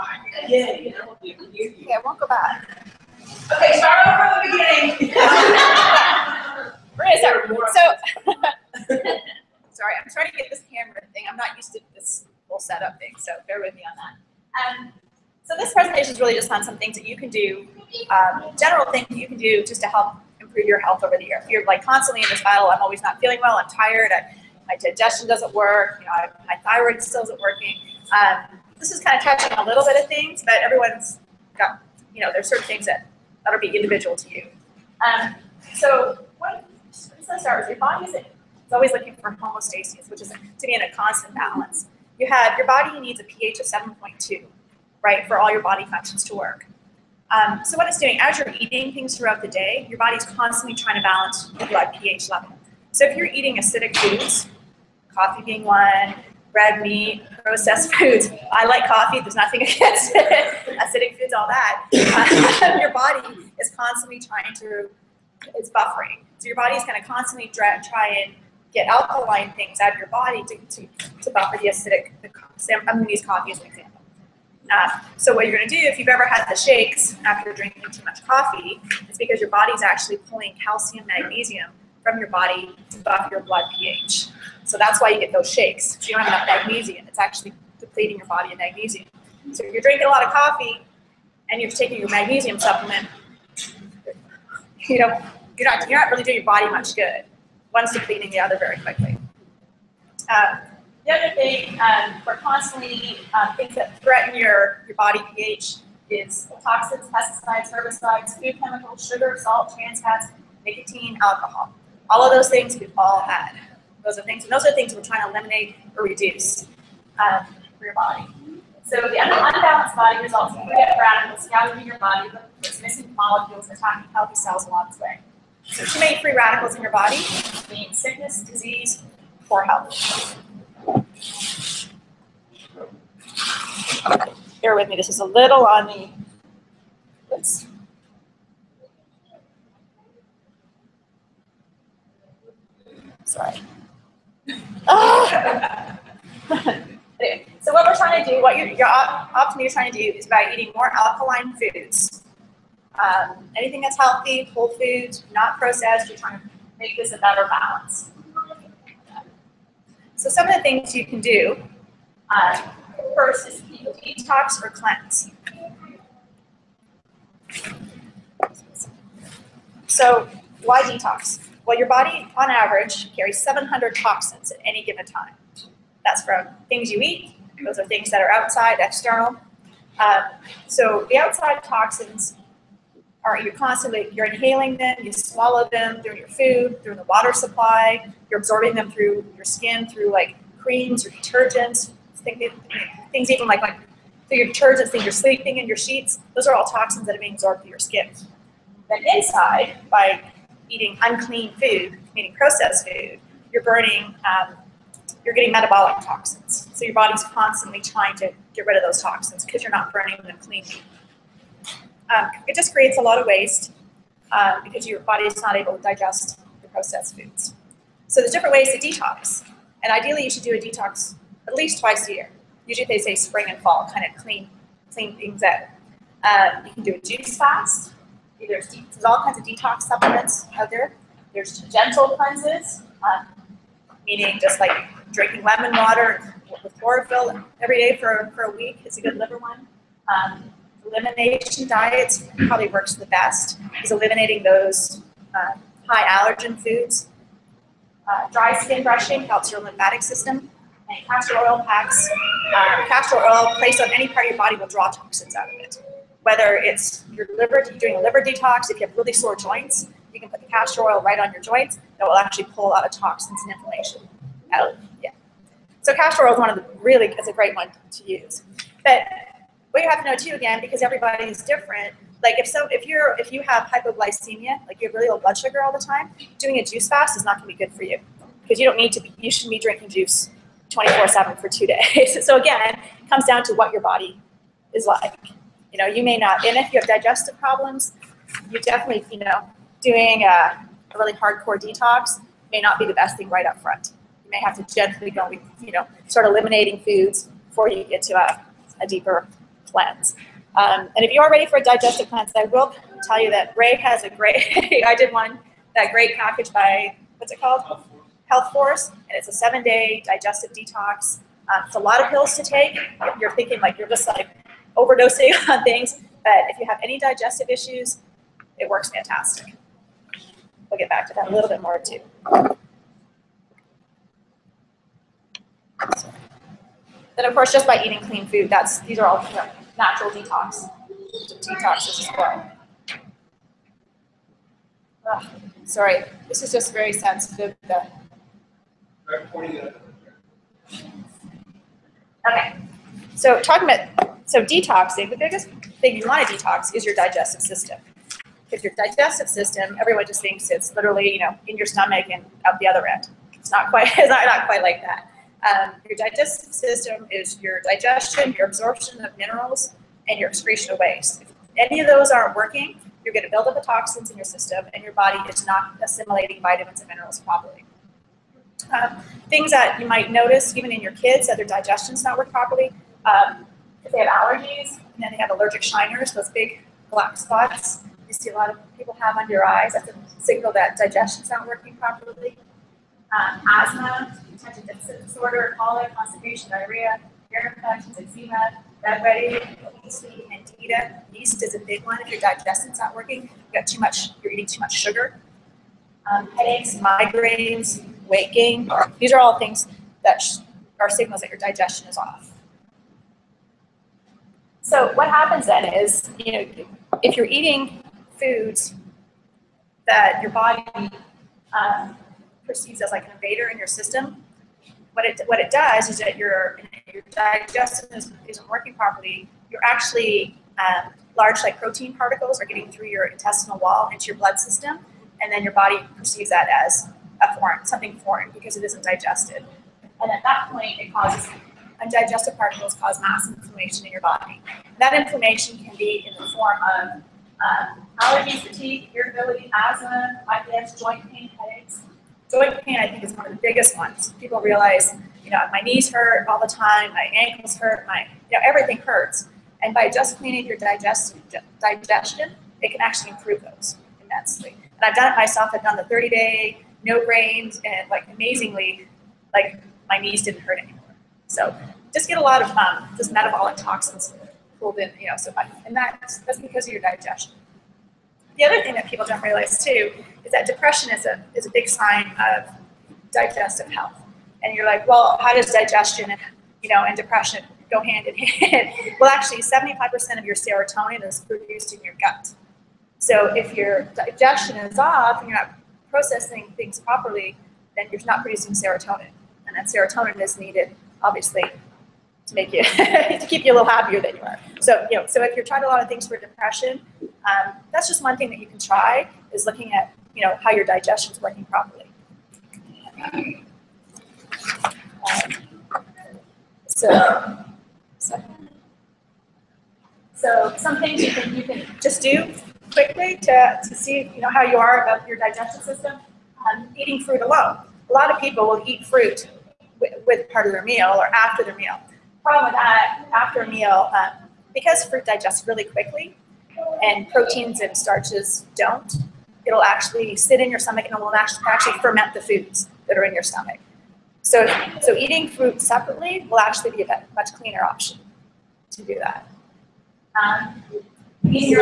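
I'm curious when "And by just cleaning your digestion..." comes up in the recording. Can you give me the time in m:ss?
7:29.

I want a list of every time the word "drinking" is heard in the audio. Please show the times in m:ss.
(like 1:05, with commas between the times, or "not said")
1:17, 1:29, 3:55, 4:39.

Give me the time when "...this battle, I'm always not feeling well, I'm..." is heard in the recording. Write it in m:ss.
0:22.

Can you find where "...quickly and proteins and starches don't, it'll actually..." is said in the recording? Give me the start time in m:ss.
8:45.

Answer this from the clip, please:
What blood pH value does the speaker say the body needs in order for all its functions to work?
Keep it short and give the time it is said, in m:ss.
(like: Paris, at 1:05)
7.2, at 0:43.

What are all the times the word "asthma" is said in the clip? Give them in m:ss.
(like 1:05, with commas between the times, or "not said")
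6:23, 7:19.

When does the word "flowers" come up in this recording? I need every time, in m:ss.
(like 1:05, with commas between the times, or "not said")
not said.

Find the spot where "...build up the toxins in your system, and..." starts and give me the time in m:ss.
6:03.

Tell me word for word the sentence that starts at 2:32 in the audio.
Um, anything that's healthy, whole foods, not processed, you're trying to make this a better balance.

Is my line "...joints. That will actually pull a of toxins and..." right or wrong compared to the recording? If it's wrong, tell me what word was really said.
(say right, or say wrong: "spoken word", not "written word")
right.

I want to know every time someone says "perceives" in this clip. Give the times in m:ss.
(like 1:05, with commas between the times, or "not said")
6:52, 7:05.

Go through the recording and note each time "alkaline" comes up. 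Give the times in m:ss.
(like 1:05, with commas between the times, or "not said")
1:08, 2:30.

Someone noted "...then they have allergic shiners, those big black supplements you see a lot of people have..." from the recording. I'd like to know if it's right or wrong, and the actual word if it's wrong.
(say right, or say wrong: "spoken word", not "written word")
wrong: "spots", not "supplements".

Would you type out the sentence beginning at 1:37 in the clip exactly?
One's depleting the other very quickly.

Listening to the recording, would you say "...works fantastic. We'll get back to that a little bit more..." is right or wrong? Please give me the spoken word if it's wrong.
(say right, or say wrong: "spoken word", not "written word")
right.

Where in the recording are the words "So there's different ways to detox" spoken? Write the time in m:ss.
3:38.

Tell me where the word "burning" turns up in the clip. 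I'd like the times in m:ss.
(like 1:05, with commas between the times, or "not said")
3:23, 3:29.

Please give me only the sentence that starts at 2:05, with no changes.
So too many free radicals in your body means sickness, disease, poor health.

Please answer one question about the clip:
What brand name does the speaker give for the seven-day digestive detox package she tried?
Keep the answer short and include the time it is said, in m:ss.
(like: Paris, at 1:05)
Health Force, at 5:08.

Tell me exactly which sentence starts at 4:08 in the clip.
Uh, dry skin brushing helps your lymphatic system.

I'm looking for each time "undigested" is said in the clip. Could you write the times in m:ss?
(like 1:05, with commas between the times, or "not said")
7:11.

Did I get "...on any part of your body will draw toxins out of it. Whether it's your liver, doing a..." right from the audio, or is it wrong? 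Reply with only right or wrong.
right.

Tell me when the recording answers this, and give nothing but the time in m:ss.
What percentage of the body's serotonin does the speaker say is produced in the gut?
7:59.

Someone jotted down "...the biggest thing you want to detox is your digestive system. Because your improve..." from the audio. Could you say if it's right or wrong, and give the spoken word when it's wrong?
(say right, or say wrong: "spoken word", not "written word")
wrong: "digestive", not "improve".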